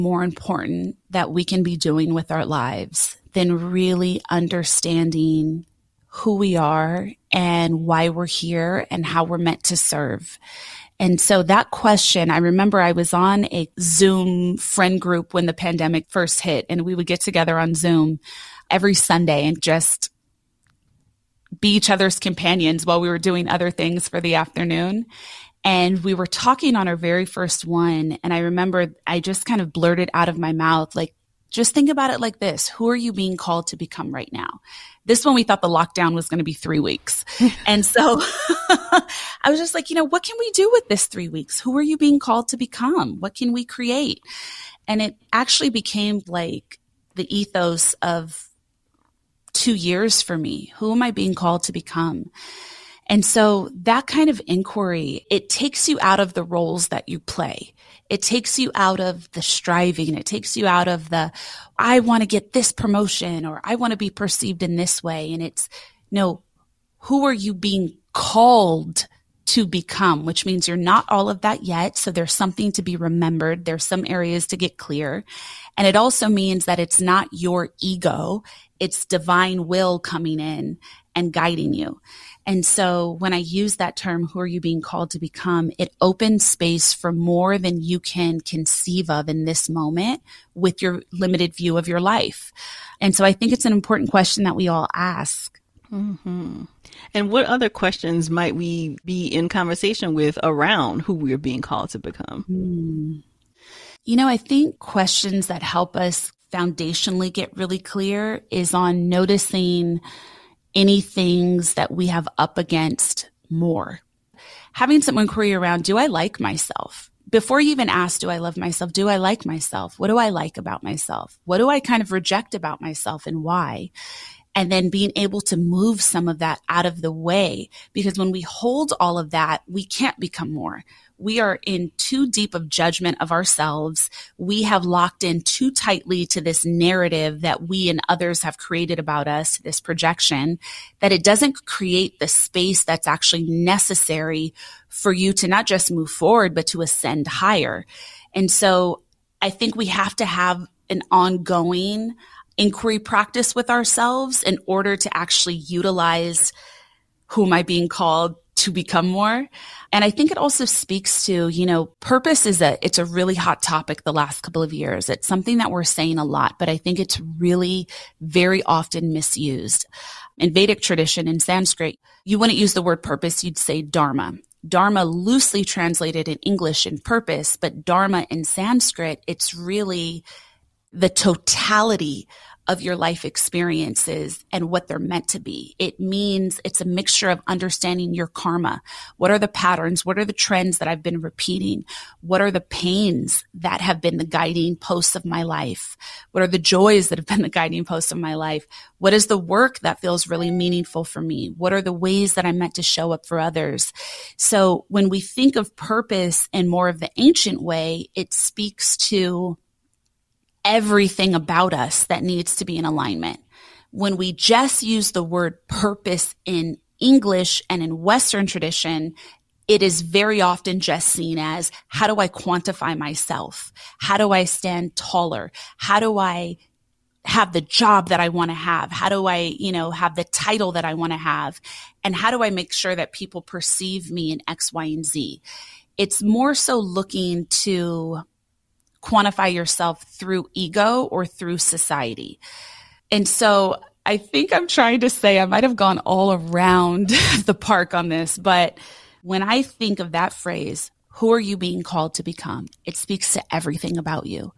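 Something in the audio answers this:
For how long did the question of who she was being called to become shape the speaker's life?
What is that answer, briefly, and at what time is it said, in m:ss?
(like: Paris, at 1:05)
2 years, at 0:49.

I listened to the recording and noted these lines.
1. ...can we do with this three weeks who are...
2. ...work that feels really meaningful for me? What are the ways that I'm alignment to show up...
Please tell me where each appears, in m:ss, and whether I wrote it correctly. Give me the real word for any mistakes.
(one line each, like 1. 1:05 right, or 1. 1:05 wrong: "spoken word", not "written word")
1. 0:40 right
2. 3:19 wrong: "meant", not "alignment".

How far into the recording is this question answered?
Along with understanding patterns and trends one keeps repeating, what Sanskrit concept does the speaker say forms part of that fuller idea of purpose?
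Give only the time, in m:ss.
3:08.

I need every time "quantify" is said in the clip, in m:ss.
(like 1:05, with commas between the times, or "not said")
3:42, 3:59.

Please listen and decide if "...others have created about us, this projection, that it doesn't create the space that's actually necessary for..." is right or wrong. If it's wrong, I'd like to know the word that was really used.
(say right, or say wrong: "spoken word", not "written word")
right.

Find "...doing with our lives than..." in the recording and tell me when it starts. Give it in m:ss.
0:01.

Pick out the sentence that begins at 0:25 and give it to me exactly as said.
And we were talking on our very first one.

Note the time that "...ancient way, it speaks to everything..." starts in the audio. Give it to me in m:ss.
3:27.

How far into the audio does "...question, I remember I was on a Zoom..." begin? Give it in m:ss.
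0:11.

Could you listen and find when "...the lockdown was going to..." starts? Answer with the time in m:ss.
0:35.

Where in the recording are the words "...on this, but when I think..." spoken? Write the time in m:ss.
4:07.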